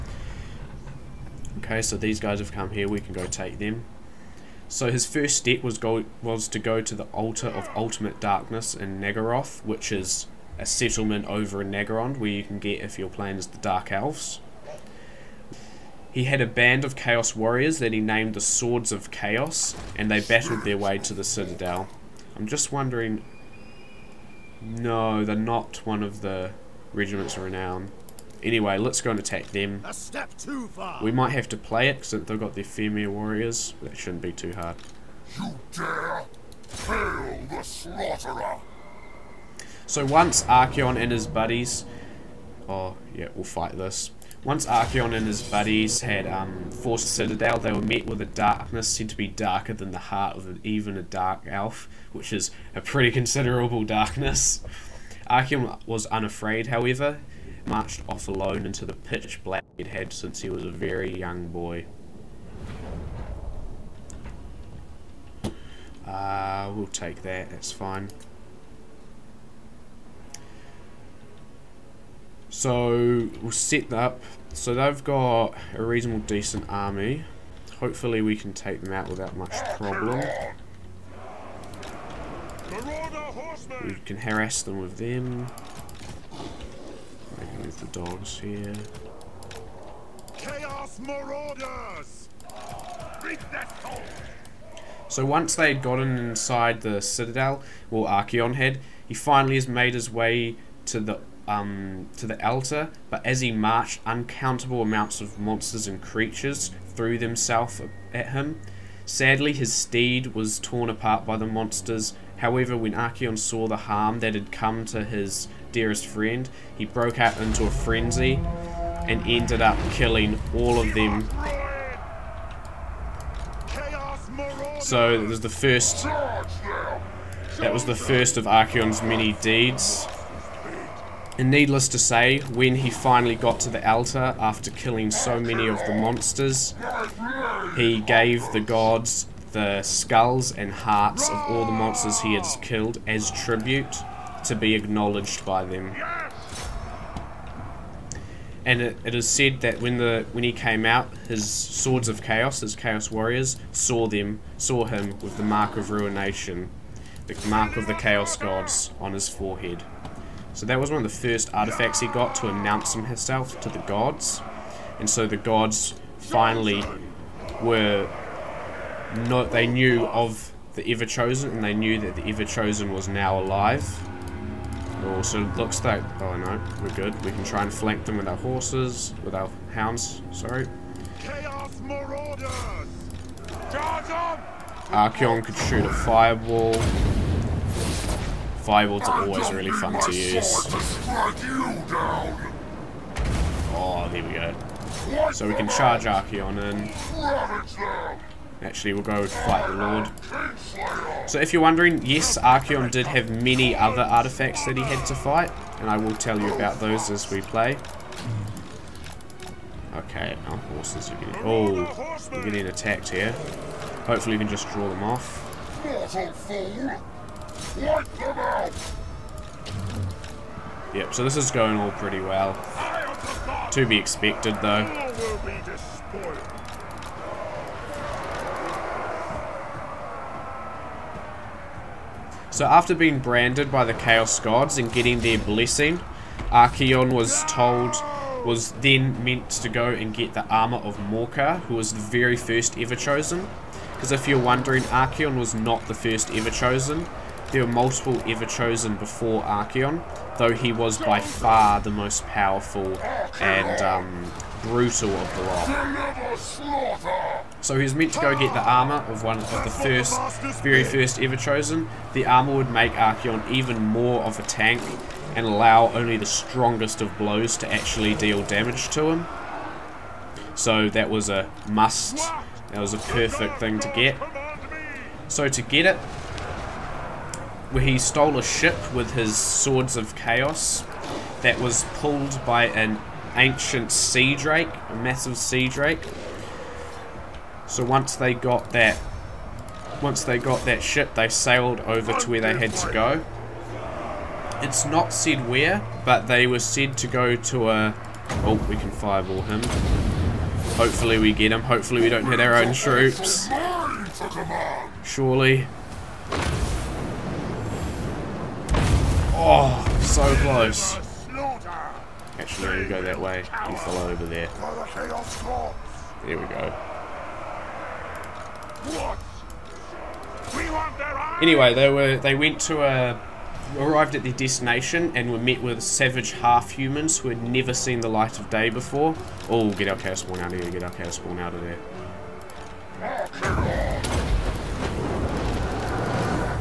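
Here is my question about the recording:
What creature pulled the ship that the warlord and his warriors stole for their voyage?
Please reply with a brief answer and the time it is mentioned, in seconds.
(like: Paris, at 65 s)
an ancient sea drake, at 283 s.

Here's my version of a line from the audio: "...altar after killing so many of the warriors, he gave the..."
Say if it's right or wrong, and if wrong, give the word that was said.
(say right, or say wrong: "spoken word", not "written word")
wrong: "monsters", not "warriors".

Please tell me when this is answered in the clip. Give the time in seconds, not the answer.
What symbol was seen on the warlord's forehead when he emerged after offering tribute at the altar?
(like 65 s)
155 s.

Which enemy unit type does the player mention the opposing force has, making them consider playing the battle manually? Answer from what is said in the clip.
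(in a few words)
Fimir warriors.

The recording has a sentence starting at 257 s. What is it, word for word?
So he was meant to go get the armor of one of the first, very first ever chosen.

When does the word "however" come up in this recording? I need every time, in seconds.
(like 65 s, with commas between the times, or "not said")
56 s, 112 s.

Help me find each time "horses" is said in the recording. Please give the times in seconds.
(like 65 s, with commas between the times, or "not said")
178 s, 210 s.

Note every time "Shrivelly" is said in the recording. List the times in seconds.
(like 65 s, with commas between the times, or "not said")
not said.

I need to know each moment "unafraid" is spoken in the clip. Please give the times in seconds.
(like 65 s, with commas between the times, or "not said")
56 s.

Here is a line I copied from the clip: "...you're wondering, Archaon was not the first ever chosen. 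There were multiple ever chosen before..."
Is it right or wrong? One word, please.
right.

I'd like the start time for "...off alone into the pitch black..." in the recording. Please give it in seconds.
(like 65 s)
58 s.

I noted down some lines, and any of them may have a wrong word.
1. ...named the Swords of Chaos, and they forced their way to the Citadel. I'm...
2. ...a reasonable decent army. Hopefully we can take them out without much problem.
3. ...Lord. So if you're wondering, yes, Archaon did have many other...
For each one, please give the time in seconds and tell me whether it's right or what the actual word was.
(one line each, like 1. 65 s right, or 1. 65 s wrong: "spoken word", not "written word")
1. 18 s wrong: "battled", not "forced"
2. 75 s right
3. 199 s right.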